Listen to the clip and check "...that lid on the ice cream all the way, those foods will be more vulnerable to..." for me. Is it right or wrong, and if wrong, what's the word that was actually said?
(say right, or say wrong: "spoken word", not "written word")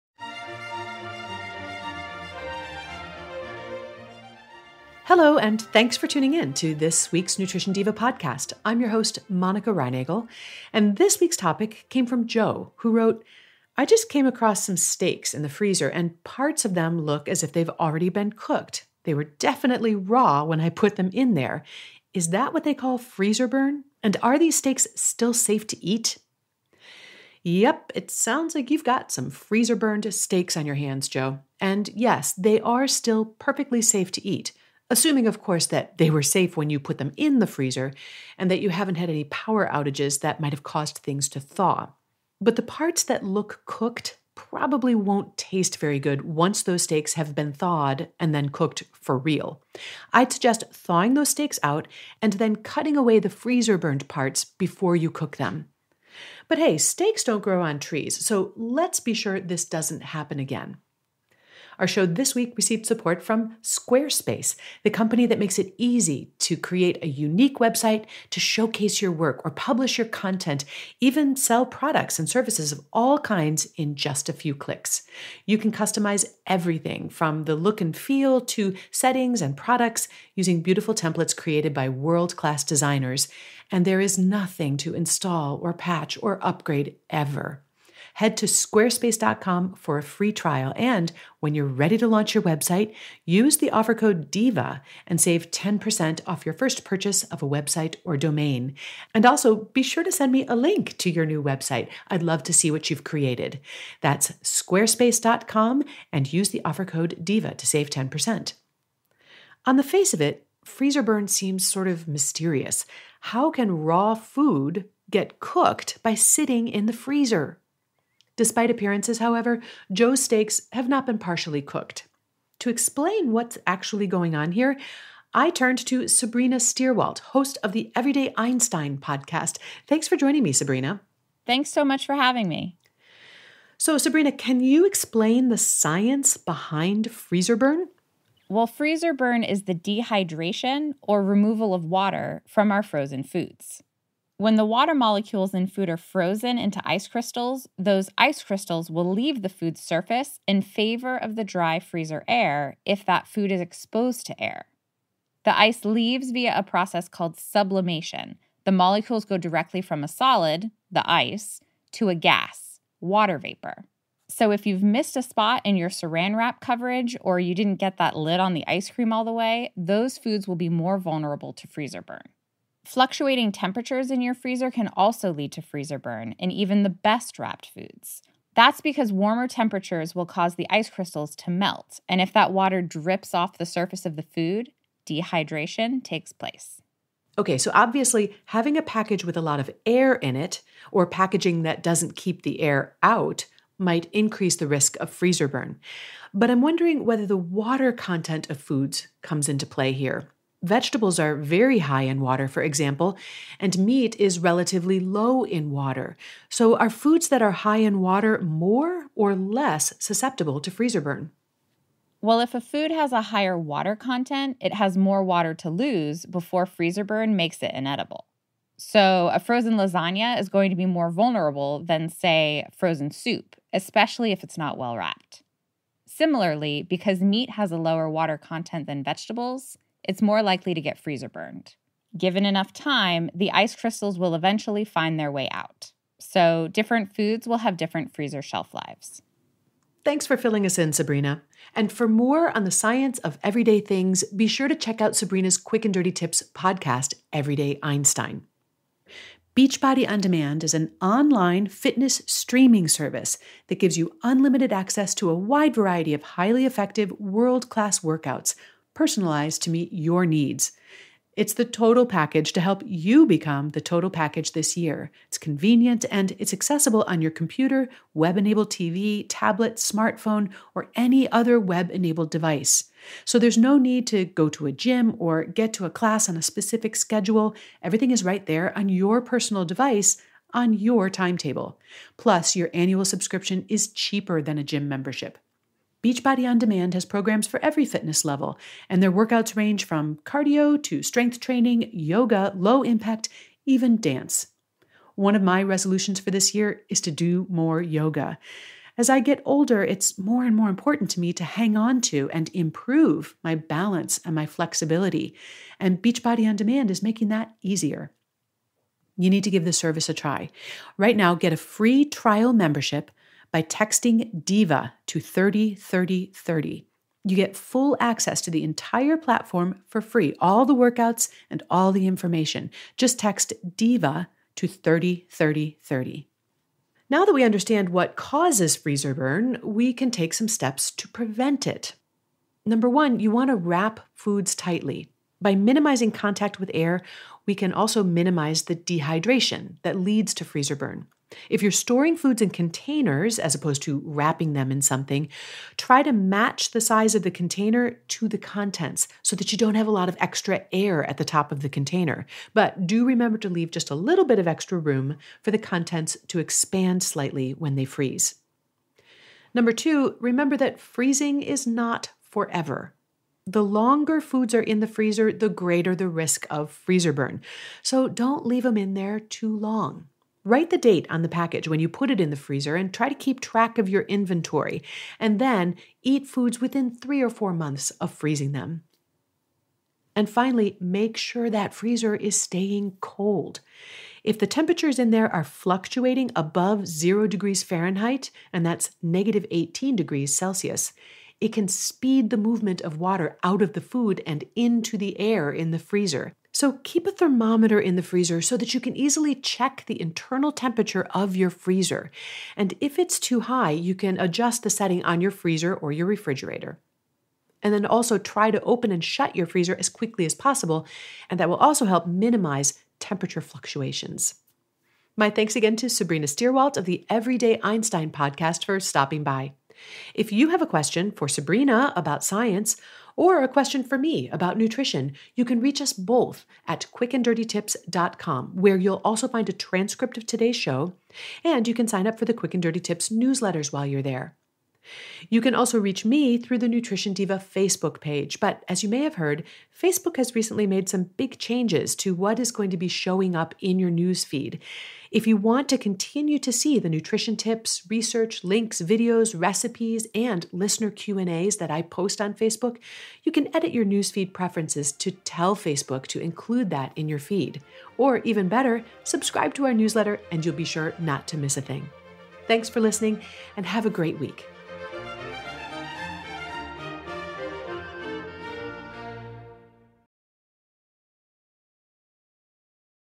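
right.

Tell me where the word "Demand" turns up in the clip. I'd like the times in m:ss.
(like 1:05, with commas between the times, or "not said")
4:10, 4:46, 5:06.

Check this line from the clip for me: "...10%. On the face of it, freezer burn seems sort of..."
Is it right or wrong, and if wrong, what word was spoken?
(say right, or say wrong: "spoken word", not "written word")
right.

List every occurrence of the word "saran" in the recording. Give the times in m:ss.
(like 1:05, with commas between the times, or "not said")
2:45.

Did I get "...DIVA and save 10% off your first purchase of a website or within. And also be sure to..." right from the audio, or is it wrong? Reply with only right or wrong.
wrong.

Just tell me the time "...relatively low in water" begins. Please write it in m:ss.
3:24.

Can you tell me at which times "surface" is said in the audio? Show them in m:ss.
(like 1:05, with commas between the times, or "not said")
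2:29, 3:03.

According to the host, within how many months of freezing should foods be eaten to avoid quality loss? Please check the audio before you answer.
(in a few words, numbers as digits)
3 or 4 months.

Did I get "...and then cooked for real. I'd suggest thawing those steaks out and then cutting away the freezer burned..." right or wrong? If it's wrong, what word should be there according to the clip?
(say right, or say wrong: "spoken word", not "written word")
right.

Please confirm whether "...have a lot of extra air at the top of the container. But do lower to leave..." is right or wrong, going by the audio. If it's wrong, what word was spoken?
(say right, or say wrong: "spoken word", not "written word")
wrong: "remember", not "lower".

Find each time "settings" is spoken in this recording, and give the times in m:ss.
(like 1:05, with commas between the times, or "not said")
1:18, 6:44.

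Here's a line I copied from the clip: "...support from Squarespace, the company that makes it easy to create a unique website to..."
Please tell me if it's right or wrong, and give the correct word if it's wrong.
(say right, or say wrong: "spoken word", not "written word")
right.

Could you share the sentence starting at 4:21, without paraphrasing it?
It's the total package to help you become the total package this year.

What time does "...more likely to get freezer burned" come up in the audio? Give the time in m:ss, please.
3:50.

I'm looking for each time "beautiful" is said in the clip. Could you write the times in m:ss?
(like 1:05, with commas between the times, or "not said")
1:20.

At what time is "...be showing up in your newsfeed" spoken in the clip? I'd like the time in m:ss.
7:22.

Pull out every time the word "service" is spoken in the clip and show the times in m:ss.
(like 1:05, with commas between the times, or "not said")
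1:12, 4:12, 5:09.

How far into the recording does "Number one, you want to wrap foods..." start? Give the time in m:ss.
5:32.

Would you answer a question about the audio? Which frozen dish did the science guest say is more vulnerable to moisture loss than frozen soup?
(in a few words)
lasagna.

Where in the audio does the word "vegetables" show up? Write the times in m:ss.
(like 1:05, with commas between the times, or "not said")
3:20, 3:49.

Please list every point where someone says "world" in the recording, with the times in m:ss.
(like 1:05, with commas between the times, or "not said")
1:21, 4:17.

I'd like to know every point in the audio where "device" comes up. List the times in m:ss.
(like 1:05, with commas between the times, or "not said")
4:32, 4:39.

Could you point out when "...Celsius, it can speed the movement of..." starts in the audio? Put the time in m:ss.
6:30.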